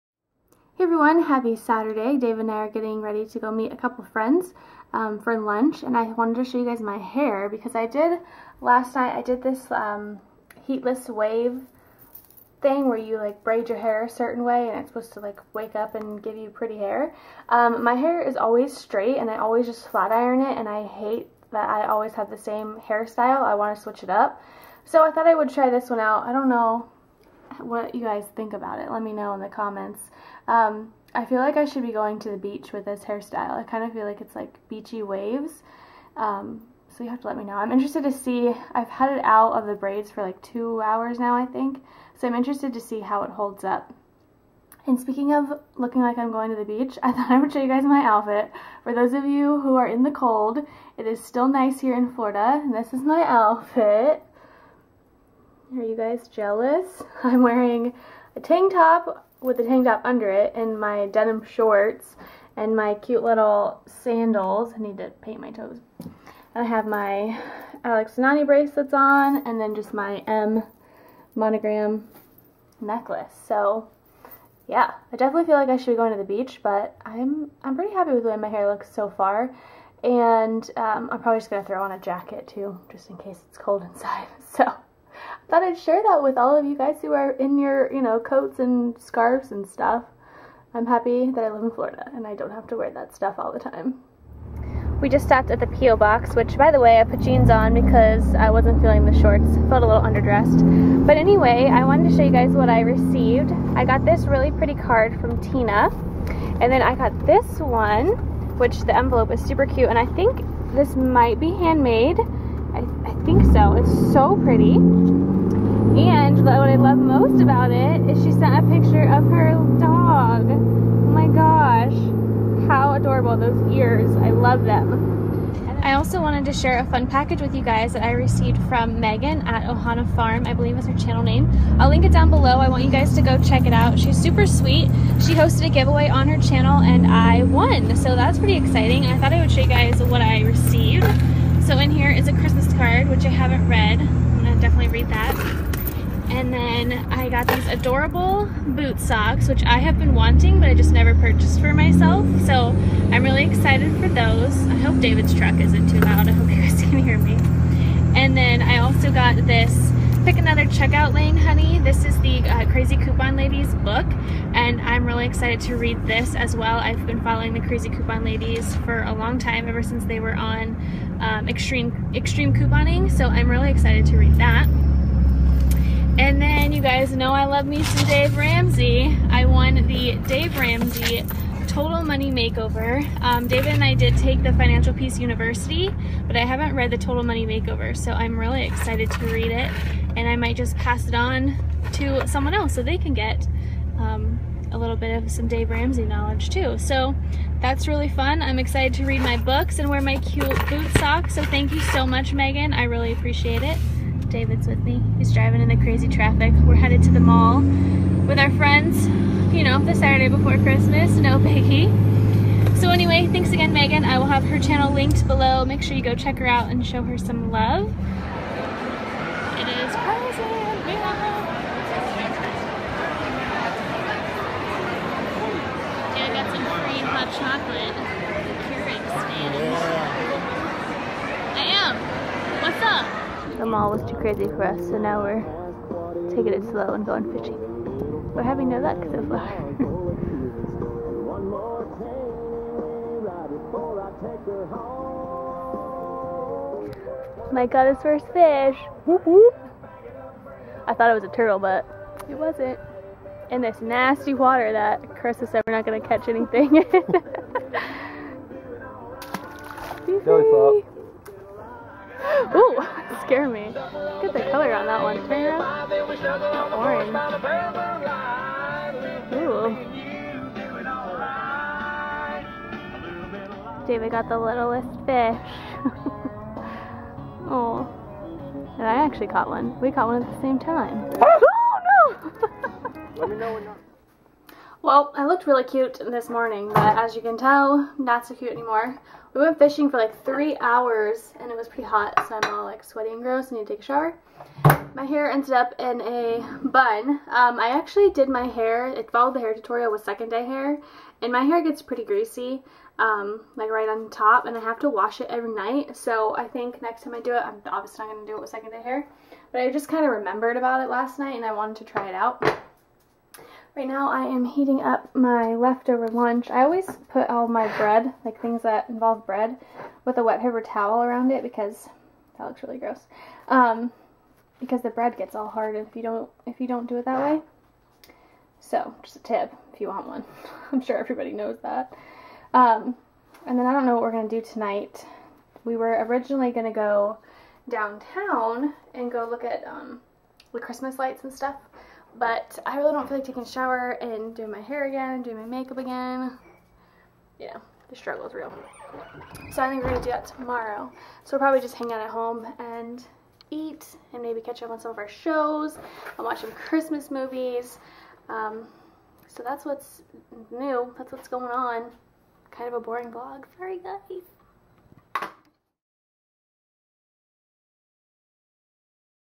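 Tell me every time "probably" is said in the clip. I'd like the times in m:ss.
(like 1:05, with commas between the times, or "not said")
1:21, 5:51.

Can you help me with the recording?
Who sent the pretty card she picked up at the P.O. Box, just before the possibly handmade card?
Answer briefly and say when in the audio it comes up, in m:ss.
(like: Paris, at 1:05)
Tina, at 1:45.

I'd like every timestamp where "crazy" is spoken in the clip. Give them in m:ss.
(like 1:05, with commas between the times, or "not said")
3:25, 3:39, 3:54.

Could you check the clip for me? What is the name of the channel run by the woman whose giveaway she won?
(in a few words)
Ohana Farm.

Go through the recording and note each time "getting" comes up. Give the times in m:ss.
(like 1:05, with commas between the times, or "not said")
0:02.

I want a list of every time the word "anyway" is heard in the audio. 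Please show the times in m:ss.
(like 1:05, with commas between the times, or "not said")
1:41, 3:32.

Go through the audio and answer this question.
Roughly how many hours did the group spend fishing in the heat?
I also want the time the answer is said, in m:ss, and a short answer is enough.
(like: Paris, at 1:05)
3, at 4:50.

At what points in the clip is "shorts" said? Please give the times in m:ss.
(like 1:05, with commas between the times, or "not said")
1:01, 1:39.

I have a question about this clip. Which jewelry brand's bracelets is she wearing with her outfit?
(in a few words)
Alex and Ani.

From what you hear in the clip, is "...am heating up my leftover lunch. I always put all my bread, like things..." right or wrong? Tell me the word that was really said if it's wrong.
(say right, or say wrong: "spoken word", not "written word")
right.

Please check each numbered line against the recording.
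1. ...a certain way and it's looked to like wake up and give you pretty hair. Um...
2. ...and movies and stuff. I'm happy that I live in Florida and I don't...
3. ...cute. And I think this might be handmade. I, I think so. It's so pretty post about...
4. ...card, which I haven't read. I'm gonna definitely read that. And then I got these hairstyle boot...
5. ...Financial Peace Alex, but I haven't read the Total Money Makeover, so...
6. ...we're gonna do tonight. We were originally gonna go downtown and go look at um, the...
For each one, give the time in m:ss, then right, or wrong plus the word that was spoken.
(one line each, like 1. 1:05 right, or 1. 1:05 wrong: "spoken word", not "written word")
1. 0:14 wrong: "supposed", not "looked"
2. 1:28 wrong: "scarves", not "movies"
3. 1:49 right
4. 2:22 wrong: "adorable", not "hairstyle"
5. 3:04 wrong: "University", not "Alex"
6. 5:34 right.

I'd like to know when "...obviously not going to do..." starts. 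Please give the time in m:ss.
5:07.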